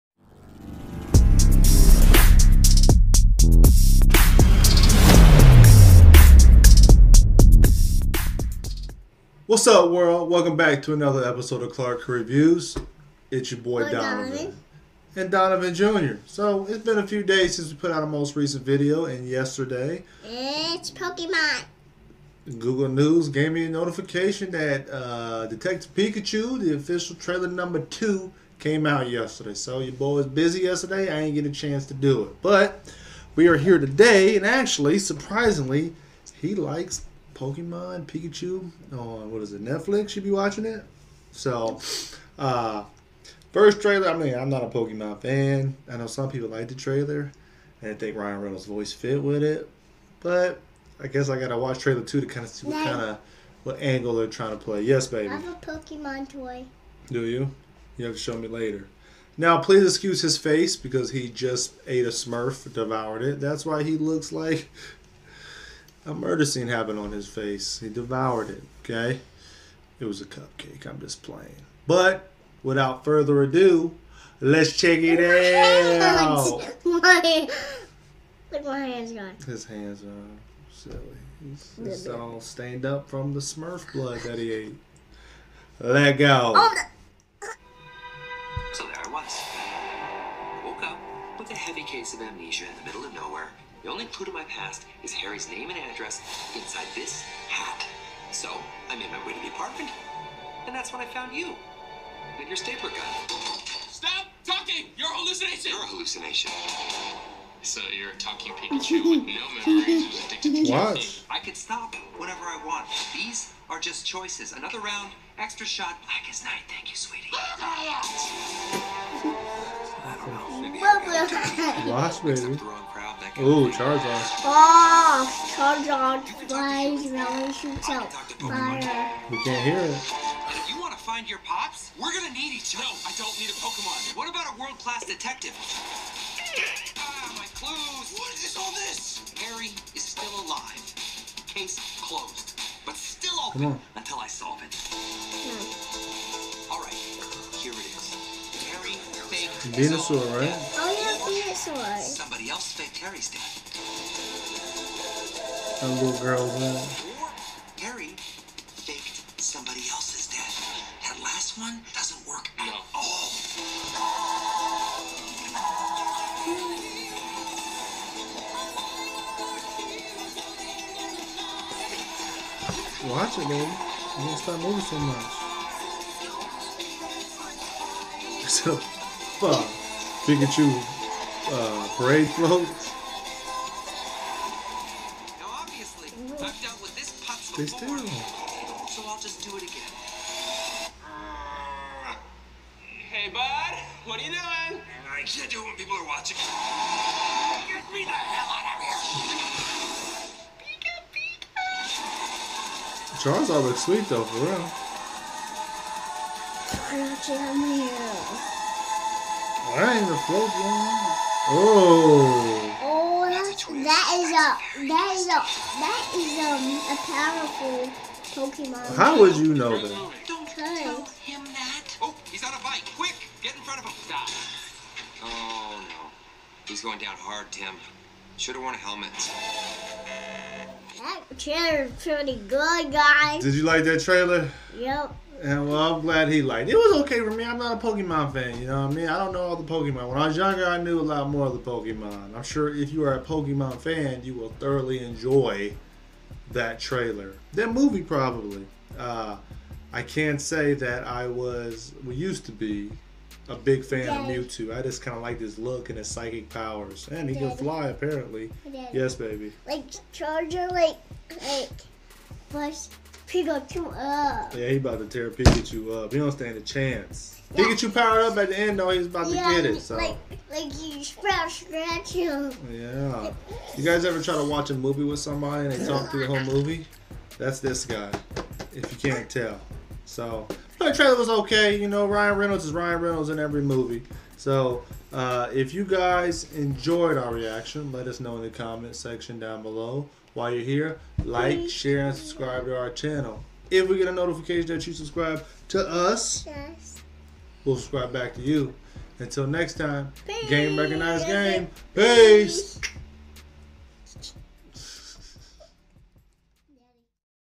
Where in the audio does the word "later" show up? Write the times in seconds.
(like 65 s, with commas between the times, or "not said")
58 s.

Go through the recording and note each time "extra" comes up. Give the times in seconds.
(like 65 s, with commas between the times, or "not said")
115 s.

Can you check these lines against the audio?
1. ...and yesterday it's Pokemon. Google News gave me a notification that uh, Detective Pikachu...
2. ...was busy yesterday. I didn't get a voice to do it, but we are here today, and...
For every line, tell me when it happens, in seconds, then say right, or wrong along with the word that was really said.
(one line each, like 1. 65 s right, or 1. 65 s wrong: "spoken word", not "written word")
1. 19 s right
2. 30 s wrong: "chance", not "voice".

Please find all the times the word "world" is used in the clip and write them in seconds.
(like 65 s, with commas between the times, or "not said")
9 s, 134 s.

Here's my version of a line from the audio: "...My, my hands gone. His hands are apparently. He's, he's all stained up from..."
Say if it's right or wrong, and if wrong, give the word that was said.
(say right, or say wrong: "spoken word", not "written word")
wrong: "silly", not "apparently".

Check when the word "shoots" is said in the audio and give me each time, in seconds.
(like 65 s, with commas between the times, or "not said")
127 s.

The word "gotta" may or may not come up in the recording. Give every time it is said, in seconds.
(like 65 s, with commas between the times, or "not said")
51 s.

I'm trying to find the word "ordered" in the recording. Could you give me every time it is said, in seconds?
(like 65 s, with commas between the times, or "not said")
not said.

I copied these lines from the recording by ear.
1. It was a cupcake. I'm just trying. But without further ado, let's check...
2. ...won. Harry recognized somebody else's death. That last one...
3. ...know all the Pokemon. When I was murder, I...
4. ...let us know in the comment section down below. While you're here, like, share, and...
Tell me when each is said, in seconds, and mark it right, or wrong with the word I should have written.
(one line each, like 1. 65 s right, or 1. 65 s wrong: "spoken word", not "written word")
1. 69 s wrong: "playing", not "trying"
2. 156 s wrong: "faked", not "recognized"
3. 239 s wrong: "younger", not "murder"
4. 287 s right.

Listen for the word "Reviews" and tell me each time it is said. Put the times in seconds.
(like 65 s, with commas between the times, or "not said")
12 s.